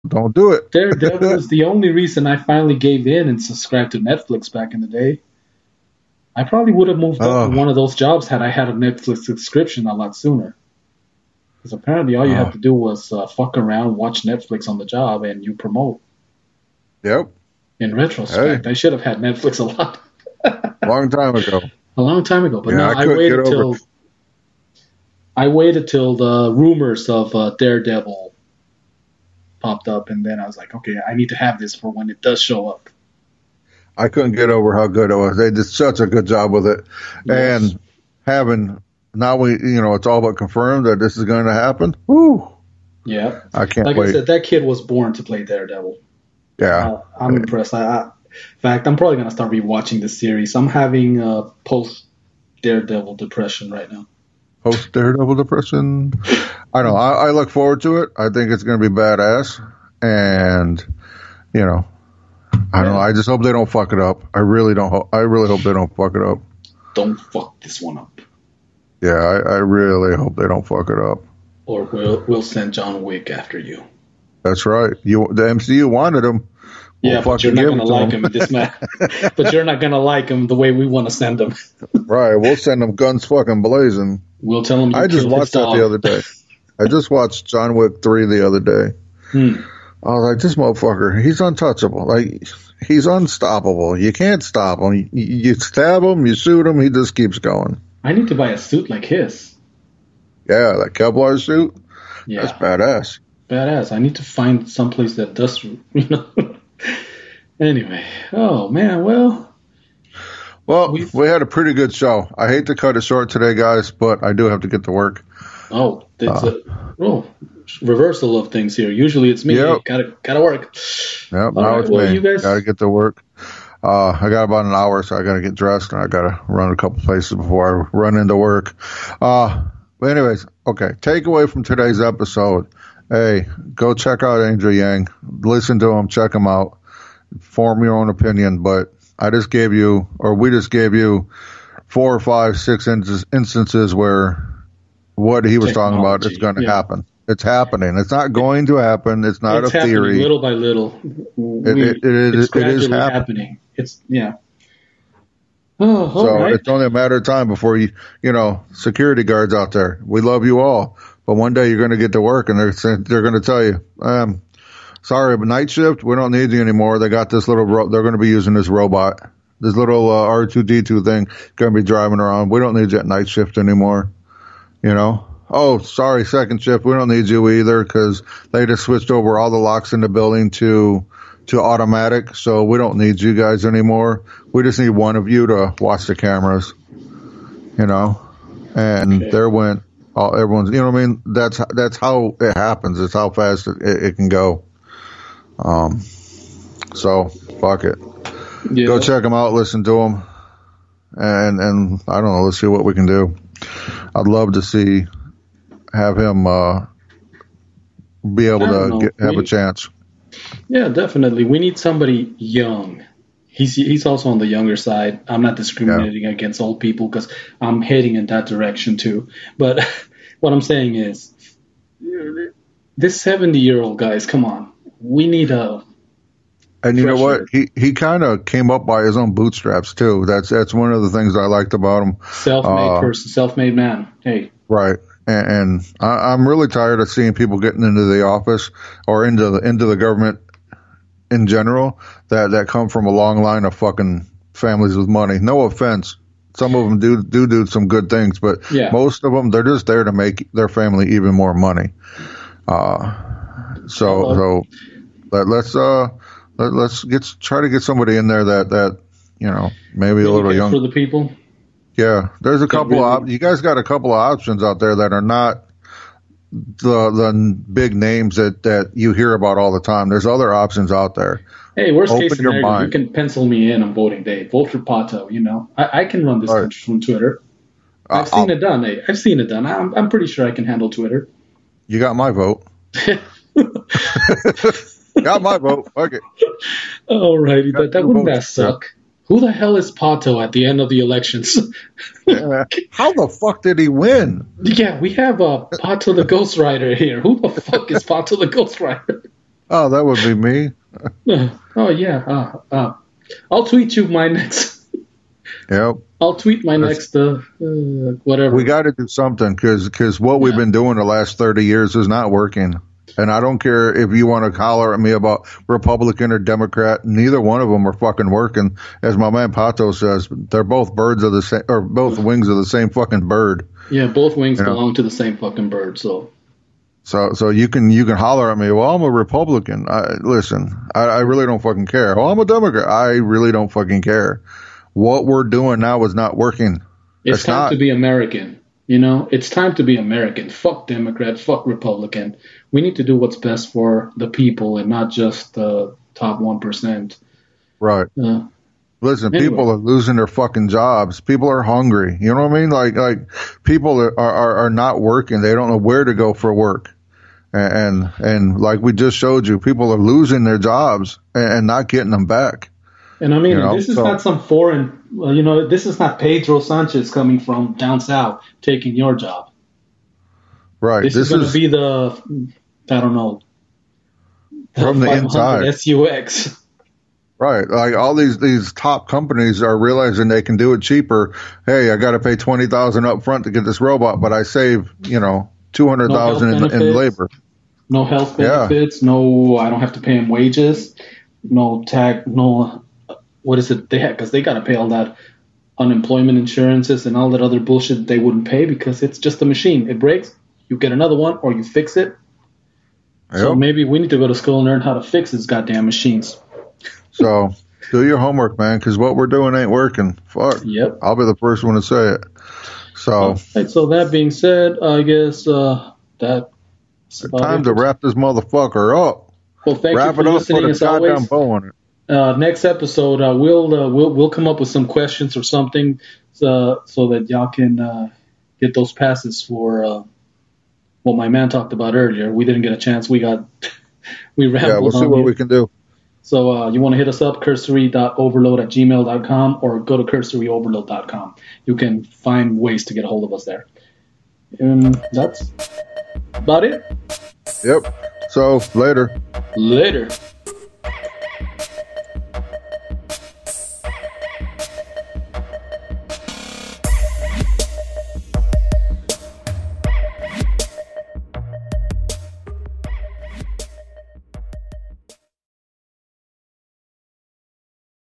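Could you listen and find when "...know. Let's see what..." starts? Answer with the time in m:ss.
3:22.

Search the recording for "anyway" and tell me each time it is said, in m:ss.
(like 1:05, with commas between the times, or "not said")
1:47, 2:10, 5:49.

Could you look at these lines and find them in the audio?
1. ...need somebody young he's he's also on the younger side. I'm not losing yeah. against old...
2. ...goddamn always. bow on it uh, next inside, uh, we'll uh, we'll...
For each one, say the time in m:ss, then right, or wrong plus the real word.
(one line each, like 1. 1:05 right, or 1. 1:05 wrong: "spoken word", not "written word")
1. 3:31 wrong: "discriminating", not "losing"
2. 7:00 wrong: "episode", not "inside".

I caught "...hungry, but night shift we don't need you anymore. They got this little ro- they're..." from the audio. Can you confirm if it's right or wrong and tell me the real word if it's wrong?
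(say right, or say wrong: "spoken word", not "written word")
wrong: "sorry", not "hungry".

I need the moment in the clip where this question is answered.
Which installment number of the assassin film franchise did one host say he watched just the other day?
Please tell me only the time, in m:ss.
1:27.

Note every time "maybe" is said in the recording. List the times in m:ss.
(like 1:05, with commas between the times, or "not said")
4:19, 6:43.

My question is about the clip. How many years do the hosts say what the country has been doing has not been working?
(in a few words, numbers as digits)
30.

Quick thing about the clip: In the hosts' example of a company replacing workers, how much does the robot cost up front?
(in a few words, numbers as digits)
20000.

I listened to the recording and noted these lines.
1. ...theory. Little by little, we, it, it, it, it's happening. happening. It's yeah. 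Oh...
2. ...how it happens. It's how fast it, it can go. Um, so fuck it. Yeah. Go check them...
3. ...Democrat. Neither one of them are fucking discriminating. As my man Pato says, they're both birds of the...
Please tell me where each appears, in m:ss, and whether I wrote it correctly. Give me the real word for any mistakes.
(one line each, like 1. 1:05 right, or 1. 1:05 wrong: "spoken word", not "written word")
1. 2:29 right
2. 3:11 right
3. 5:16 wrong: "working", not "discriminating".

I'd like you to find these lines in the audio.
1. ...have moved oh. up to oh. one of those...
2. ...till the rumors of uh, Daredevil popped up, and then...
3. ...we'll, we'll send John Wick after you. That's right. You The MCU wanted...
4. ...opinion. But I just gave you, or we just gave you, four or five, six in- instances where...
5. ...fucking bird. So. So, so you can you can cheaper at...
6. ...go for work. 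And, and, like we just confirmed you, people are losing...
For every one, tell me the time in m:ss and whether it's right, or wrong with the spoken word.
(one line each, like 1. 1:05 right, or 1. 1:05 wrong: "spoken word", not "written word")
1. 0:06 right
2. 0:25 right
3. 1:11 right
4. 2:18 right
5. 5:25 wrong: "holler", not "cheaper"
6. 5:56 wrong: "showed", not "confirmed".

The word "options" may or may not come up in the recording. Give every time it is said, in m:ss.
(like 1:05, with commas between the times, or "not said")
4:24, 4:30.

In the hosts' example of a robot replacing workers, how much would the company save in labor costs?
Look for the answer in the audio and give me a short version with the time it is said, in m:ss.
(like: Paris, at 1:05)
200000, at 6:25.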